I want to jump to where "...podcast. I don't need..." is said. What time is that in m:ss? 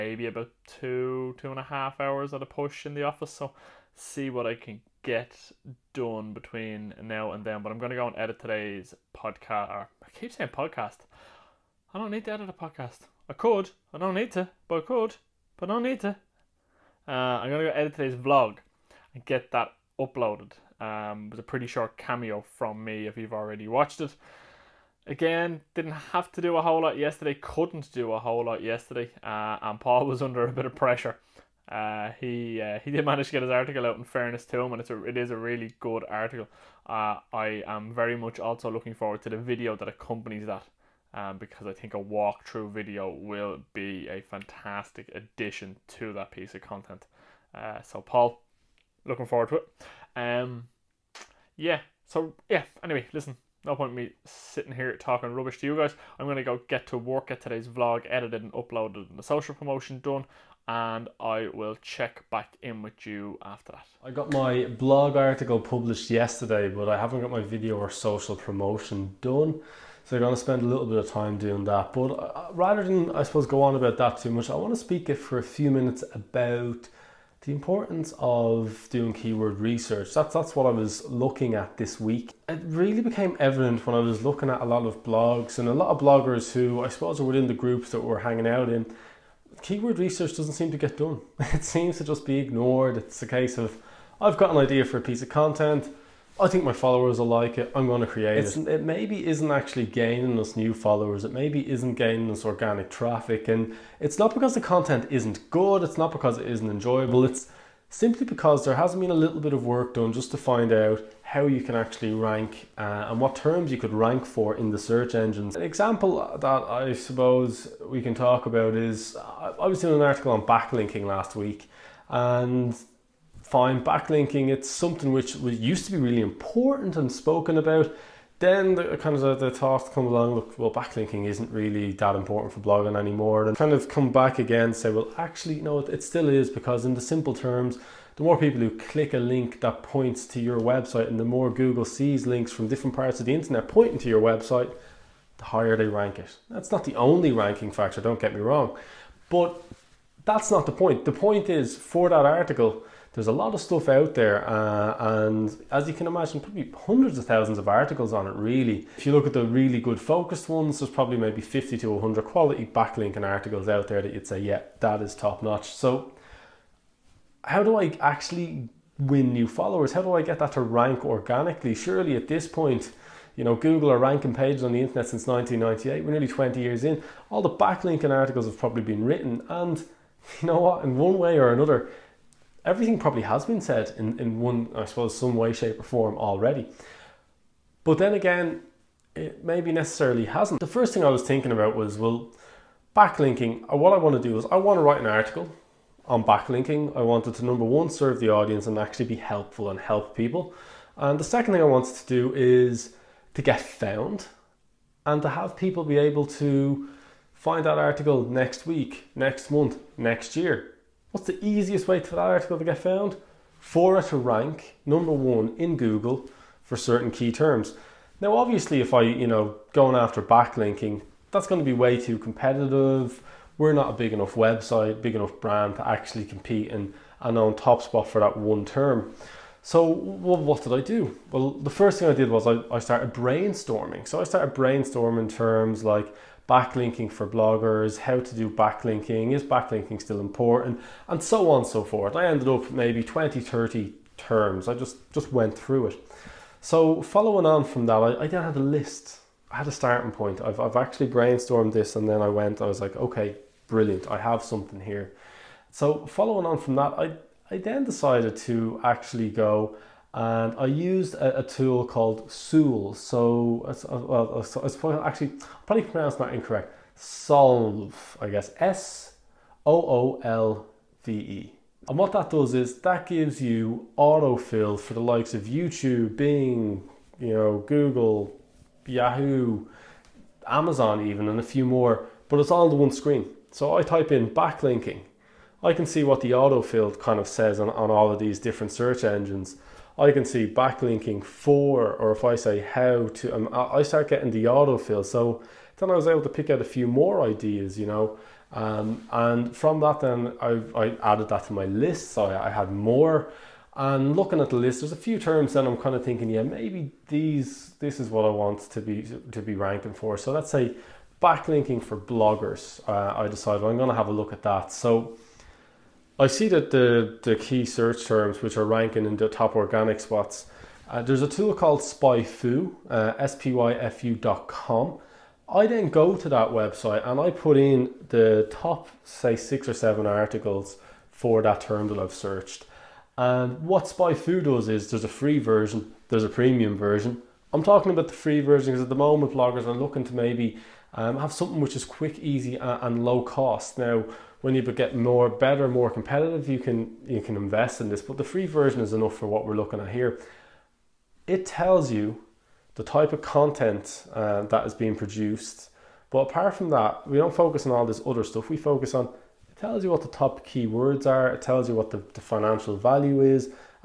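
0:10.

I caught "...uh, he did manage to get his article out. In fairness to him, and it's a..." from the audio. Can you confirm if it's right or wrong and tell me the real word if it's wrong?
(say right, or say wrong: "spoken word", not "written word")
right.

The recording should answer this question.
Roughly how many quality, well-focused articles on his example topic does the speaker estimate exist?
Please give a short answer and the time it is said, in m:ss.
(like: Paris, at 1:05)
50 to 100, at 2:41.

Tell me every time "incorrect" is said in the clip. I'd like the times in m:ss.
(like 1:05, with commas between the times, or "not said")
4:26.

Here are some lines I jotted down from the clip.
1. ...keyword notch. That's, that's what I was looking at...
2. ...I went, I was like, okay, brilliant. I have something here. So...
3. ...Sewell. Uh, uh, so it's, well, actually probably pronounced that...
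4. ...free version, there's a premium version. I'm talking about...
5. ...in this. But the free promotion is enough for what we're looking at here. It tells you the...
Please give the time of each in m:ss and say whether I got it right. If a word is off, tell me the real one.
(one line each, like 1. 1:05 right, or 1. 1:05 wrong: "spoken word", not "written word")
1. 1:19 wrong: "research", not "notch"
2. 4:12 right
3. 4:22 right
4. 5:35 right
5. 5:47 wrong: "version", not "promotion".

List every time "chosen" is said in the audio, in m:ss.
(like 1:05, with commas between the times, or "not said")
not said.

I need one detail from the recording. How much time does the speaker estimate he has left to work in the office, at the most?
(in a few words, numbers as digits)
2 and a half hours.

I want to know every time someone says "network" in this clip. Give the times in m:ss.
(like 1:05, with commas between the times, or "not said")
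not said.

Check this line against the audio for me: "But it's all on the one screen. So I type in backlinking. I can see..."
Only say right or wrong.
right.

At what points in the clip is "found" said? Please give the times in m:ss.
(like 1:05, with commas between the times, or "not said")
3:23, 3:32.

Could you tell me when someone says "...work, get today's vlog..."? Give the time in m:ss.
0:56.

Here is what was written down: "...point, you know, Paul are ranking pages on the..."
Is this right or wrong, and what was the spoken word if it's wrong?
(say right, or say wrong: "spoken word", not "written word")
wrong: "Google", not "Paul".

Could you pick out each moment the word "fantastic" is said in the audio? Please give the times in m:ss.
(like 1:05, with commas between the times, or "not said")
0:44.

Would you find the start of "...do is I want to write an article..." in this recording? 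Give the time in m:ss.
3:14.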